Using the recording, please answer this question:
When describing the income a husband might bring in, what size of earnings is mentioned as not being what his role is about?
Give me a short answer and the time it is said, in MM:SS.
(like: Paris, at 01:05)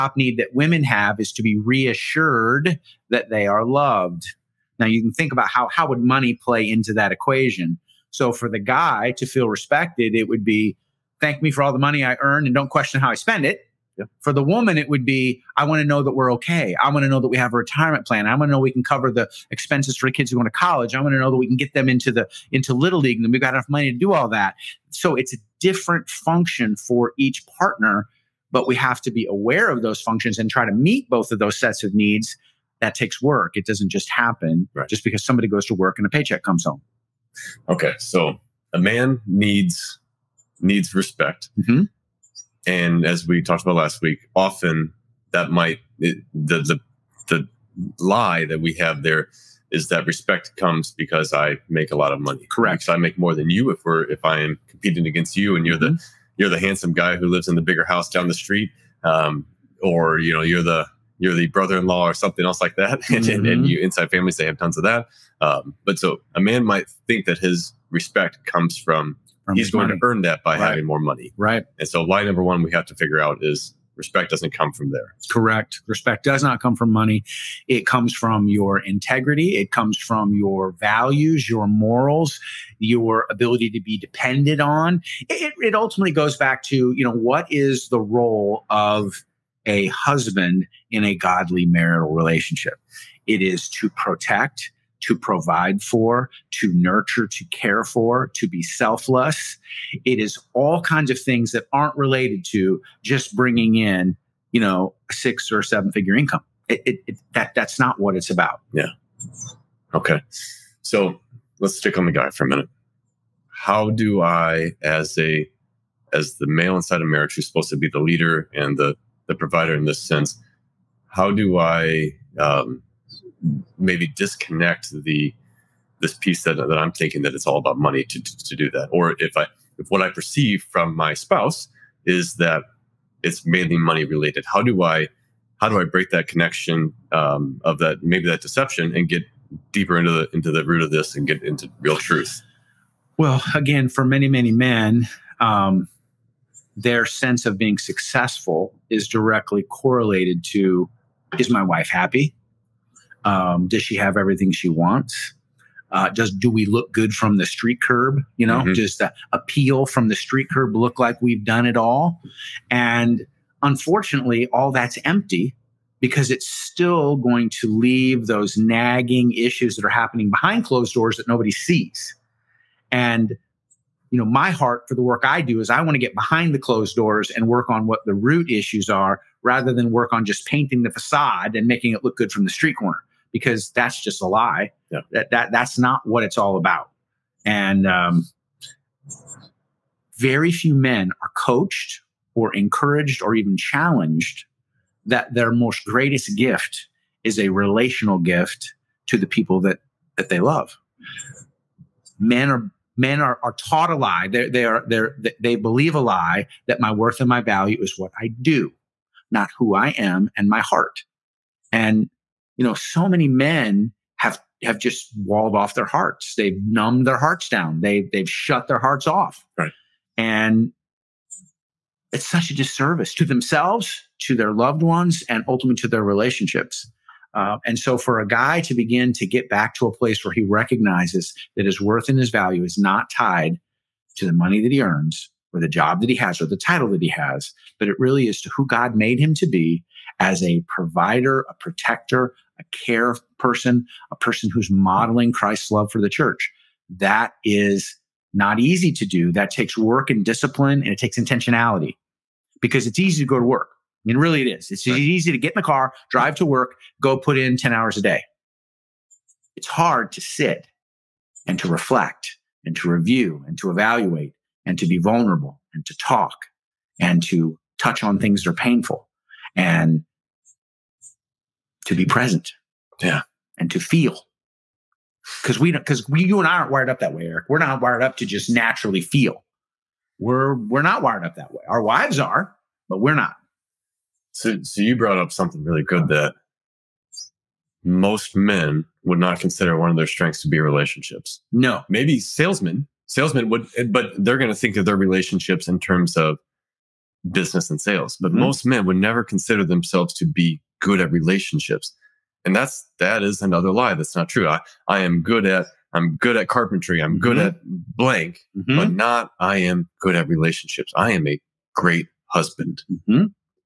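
six or seven figure, at 01:45.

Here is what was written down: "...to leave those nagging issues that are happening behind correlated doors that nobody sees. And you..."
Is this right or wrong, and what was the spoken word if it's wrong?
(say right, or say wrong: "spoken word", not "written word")
wrong: "closed", not "correlated".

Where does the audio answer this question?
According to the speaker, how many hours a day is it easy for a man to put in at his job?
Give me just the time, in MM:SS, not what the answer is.
04:17.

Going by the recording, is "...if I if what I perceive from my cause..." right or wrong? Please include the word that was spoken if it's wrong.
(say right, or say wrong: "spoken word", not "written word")
wrong: "spouse", not "cause".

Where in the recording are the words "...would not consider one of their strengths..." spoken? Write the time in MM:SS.
04:49.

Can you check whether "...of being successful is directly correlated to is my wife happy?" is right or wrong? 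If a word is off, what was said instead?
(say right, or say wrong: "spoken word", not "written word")
right.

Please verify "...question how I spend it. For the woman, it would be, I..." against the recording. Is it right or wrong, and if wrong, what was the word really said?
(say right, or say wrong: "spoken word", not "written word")
right.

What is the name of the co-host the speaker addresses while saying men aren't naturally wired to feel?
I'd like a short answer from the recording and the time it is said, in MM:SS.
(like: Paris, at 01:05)
Eric, at 04:37.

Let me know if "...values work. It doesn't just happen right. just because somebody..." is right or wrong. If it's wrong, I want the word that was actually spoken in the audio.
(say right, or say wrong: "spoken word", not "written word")
wrong: "takes", not "values".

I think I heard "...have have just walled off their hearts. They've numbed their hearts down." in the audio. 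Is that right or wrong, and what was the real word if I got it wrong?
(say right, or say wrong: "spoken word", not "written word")
right.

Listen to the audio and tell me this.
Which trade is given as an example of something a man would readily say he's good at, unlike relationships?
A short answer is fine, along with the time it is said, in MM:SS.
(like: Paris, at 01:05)
carpentry, at 05:06.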